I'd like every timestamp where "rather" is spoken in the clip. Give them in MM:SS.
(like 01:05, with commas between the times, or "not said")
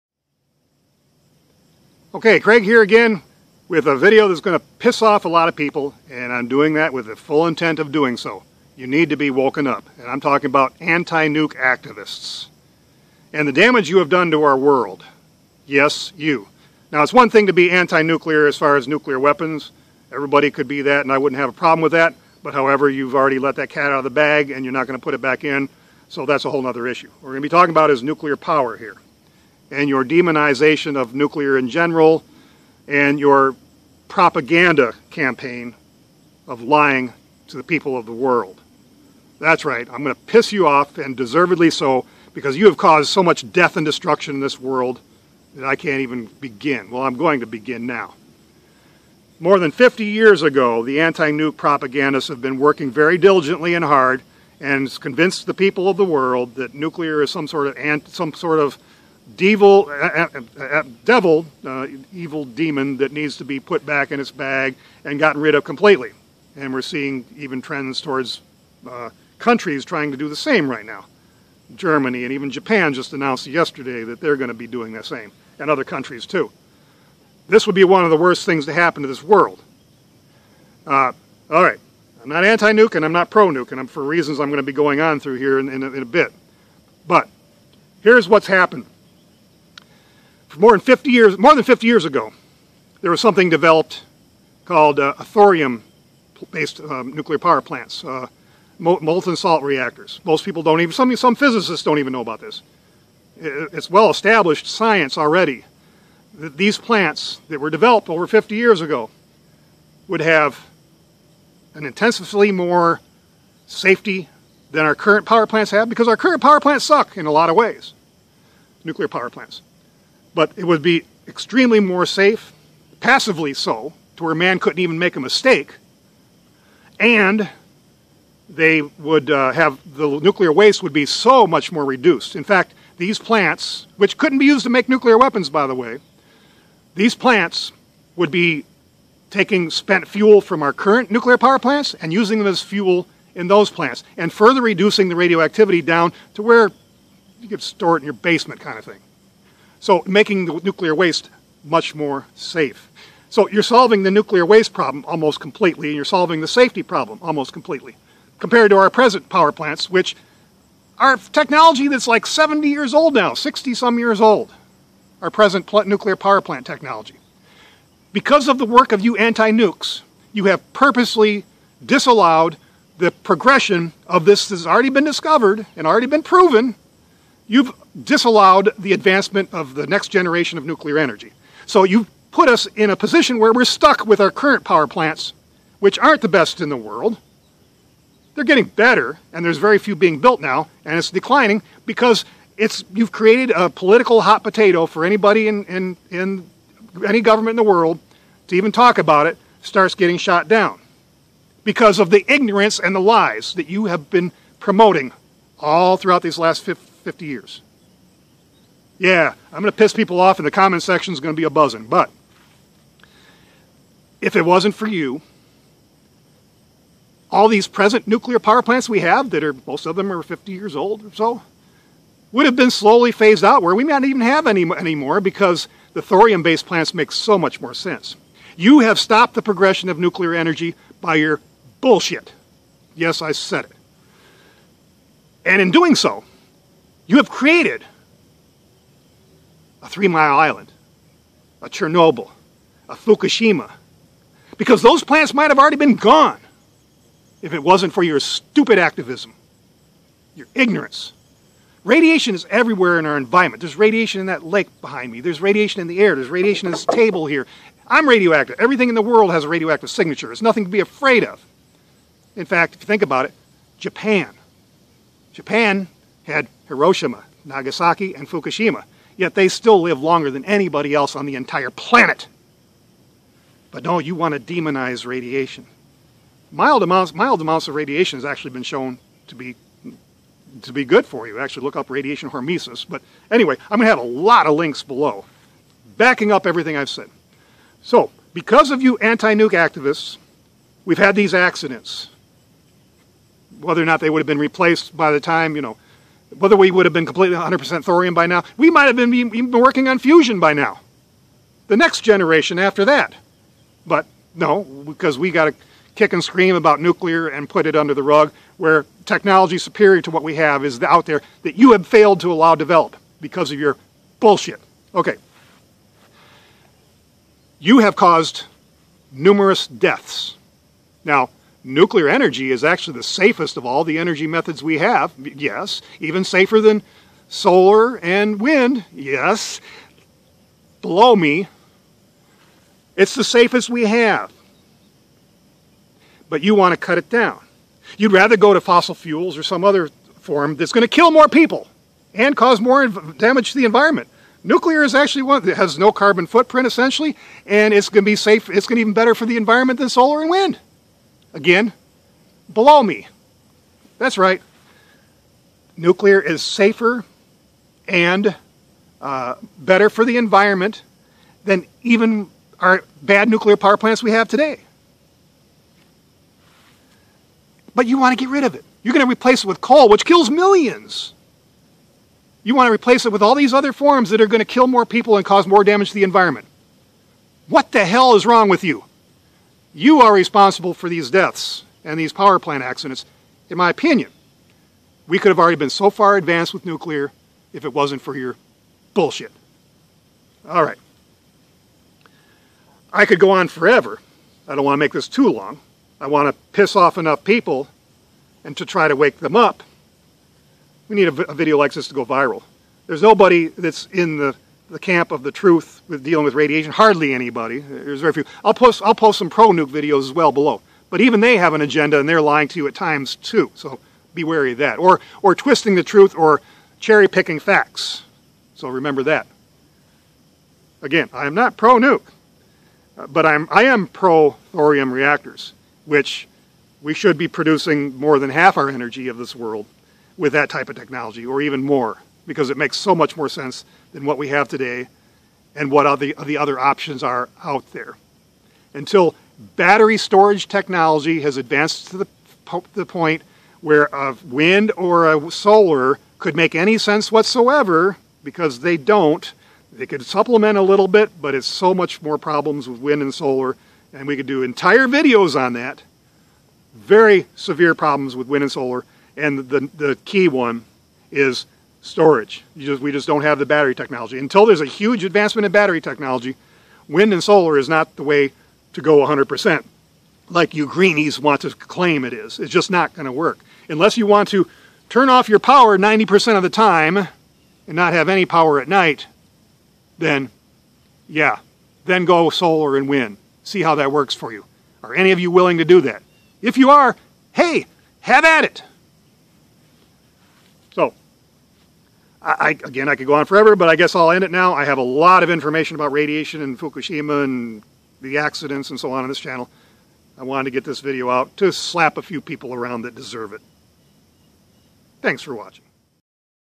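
05:38.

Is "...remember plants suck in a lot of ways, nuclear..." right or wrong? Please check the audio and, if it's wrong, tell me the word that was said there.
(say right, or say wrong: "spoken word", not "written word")
wrong: "power", not "remember".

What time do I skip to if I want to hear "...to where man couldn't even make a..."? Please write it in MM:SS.
02:04.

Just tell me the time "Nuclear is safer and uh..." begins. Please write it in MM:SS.
05:55.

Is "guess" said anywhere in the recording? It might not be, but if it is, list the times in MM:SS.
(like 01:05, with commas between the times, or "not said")
08:13.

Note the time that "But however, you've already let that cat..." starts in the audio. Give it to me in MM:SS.
00:22.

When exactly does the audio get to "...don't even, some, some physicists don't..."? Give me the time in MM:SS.
01:40.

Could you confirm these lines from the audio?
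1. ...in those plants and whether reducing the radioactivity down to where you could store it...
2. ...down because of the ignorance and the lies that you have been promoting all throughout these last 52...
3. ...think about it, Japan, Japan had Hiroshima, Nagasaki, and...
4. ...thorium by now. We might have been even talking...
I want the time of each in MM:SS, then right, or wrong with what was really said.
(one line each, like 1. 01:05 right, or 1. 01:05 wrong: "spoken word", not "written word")
1. 02:23 wrong: "further", not "whether"
2. 03:20 wrong: "50", not "52"
3. 04:22 right
4. 04:57 wrong: "working", not "talking".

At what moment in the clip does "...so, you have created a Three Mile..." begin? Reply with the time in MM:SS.
03:55.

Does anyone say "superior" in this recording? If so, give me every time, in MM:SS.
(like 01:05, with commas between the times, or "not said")
05:09.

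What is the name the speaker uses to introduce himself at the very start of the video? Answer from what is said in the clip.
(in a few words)
Craig.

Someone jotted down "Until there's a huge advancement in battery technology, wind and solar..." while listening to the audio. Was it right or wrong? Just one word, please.
right.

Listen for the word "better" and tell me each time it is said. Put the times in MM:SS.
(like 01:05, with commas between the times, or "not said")
03:08, 05:48, 05:59.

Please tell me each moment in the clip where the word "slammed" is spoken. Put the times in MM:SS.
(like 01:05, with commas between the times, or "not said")
not said.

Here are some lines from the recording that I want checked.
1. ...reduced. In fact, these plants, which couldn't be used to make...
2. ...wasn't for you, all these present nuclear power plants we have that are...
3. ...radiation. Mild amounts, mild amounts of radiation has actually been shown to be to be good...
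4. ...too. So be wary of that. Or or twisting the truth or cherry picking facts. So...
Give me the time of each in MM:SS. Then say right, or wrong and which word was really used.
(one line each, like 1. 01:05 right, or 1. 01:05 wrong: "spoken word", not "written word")
1. 02:11 right
2. 03:34 right
3. 04:35 right
4. 06:53 right.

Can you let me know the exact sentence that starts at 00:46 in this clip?
Well, I'm going to begin now.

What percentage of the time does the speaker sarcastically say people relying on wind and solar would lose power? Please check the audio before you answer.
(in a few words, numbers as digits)
90%.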